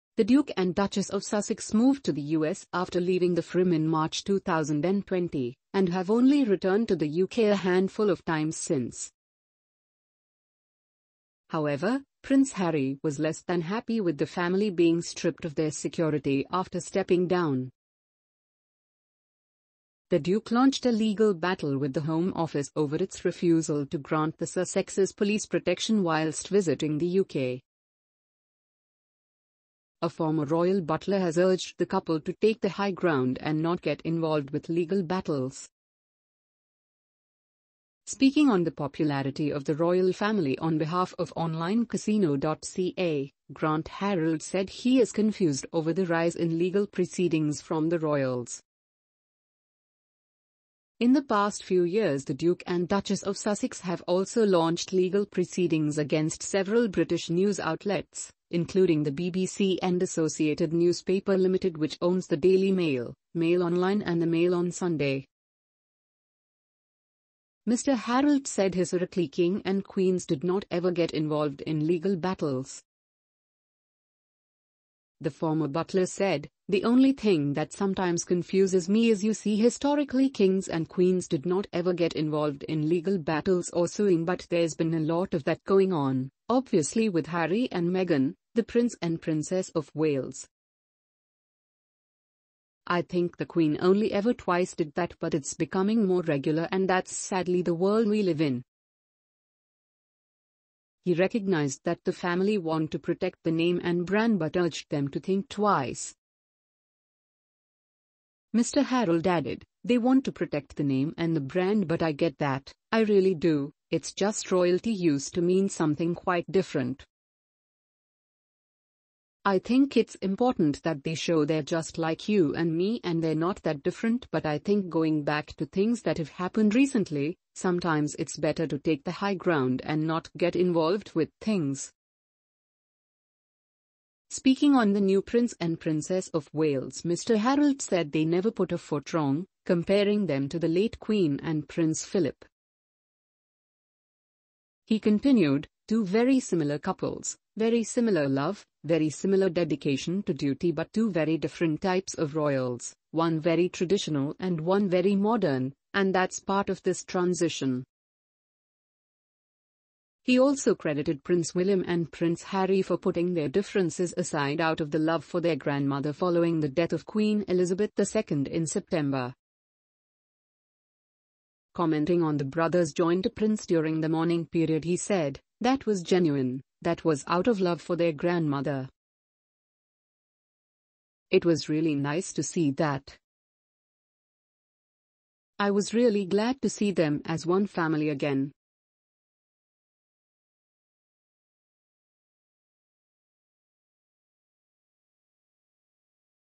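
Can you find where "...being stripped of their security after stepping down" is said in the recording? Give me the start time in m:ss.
0:14.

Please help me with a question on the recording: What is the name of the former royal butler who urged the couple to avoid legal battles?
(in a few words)
Grant Harold.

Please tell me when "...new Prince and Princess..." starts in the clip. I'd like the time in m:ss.
2:15.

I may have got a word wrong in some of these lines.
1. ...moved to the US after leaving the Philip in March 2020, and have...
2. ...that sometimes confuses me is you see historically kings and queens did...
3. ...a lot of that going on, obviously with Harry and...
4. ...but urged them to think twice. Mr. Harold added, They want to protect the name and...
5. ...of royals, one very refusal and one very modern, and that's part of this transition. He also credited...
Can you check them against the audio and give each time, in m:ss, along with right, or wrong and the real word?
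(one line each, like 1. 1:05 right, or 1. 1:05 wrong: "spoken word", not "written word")
1. 0:01 wrong: "Firm", not "Philip"
2. 1:17 right
3. 1:24 right
4. 1:44 right
5. 2:32 wrong: "traditional", not "refusal".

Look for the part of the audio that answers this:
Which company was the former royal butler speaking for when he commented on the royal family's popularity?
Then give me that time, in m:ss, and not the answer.
0:41.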